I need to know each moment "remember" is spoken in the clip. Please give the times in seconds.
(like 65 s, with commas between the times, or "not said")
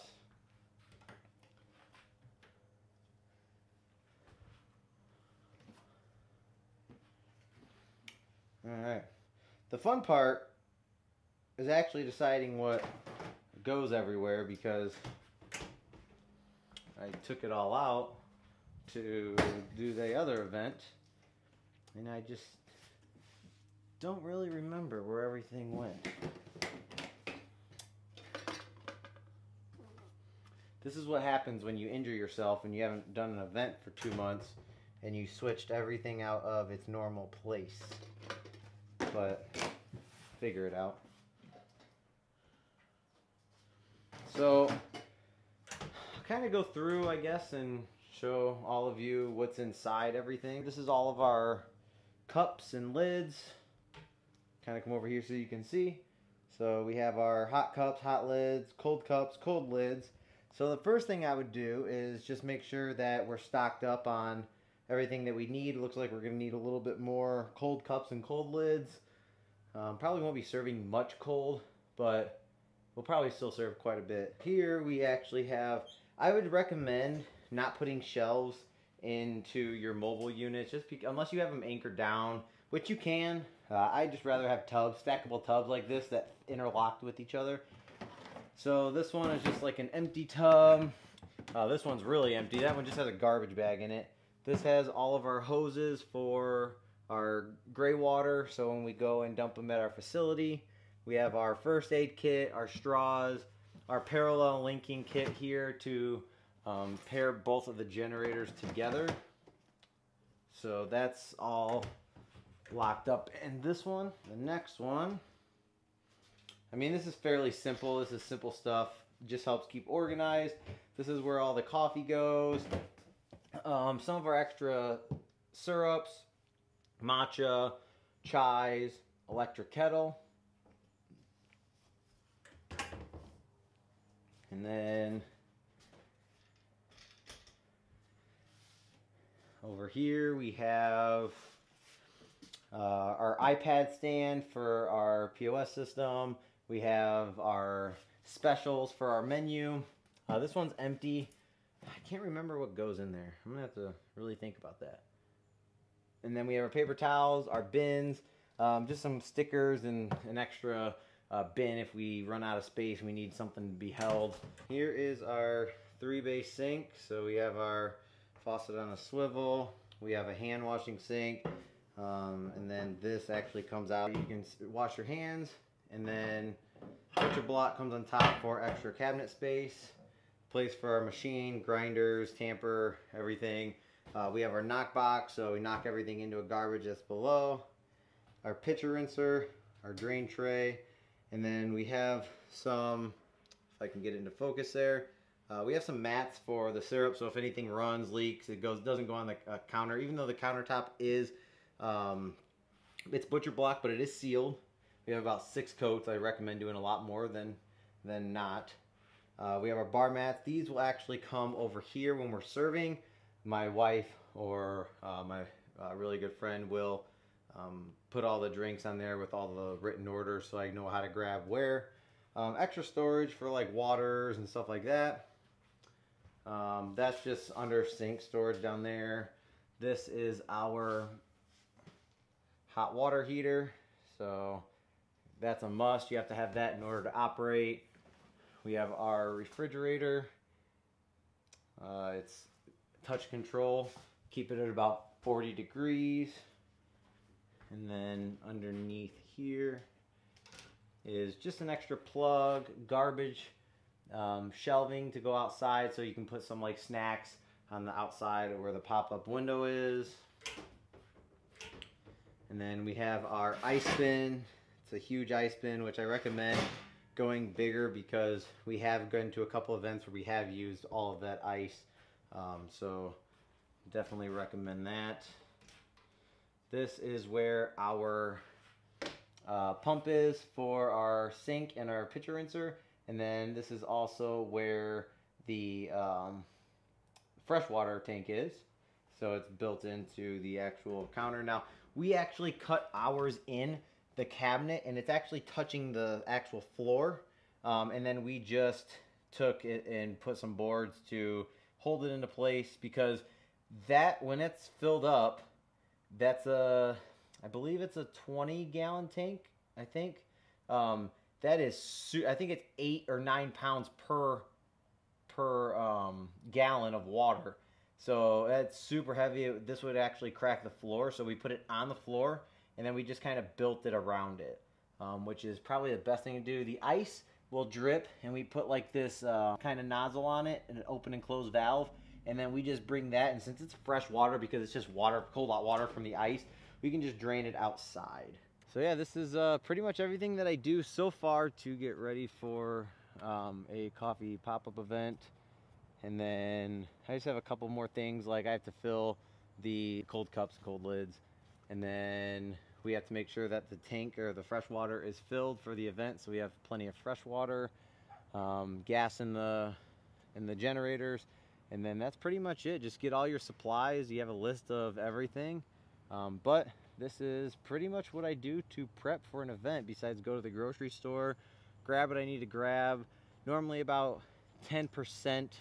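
24 s, 152 s.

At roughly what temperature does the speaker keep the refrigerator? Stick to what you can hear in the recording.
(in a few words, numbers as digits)
40 degrees.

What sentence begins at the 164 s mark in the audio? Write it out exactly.
Here is our three bay sink.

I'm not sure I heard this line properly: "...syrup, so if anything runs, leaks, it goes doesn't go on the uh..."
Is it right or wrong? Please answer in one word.
right.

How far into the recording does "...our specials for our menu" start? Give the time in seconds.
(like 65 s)
147 s.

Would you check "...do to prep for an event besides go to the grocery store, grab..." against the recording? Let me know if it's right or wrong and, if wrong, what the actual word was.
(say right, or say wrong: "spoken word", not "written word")
right.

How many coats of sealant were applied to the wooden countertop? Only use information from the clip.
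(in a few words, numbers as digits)
6.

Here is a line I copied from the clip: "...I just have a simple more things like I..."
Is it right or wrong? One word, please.
wrong.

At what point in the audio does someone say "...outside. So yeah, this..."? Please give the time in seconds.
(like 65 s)
337 s.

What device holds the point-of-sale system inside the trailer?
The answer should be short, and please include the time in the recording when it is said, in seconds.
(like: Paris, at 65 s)
iPad stand, at 143 s.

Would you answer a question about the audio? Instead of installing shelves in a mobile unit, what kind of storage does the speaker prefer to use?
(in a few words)
stackable tubs.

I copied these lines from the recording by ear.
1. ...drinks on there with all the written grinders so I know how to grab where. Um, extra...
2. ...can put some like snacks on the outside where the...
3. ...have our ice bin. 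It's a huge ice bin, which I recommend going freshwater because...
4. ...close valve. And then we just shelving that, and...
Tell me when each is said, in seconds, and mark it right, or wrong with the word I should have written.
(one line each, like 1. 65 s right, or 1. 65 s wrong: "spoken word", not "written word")
1. 218 s wrong: "orders", not "grinders"
2. 256 s right
3. 262 s wrong: "bigger", not "freshwater"
4. 331 s wrong: "bring", not "shelving".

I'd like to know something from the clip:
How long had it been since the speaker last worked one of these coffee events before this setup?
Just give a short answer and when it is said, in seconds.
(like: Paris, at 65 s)
2 months, at 33 s.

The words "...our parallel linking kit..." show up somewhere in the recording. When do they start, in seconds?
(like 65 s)
103 s.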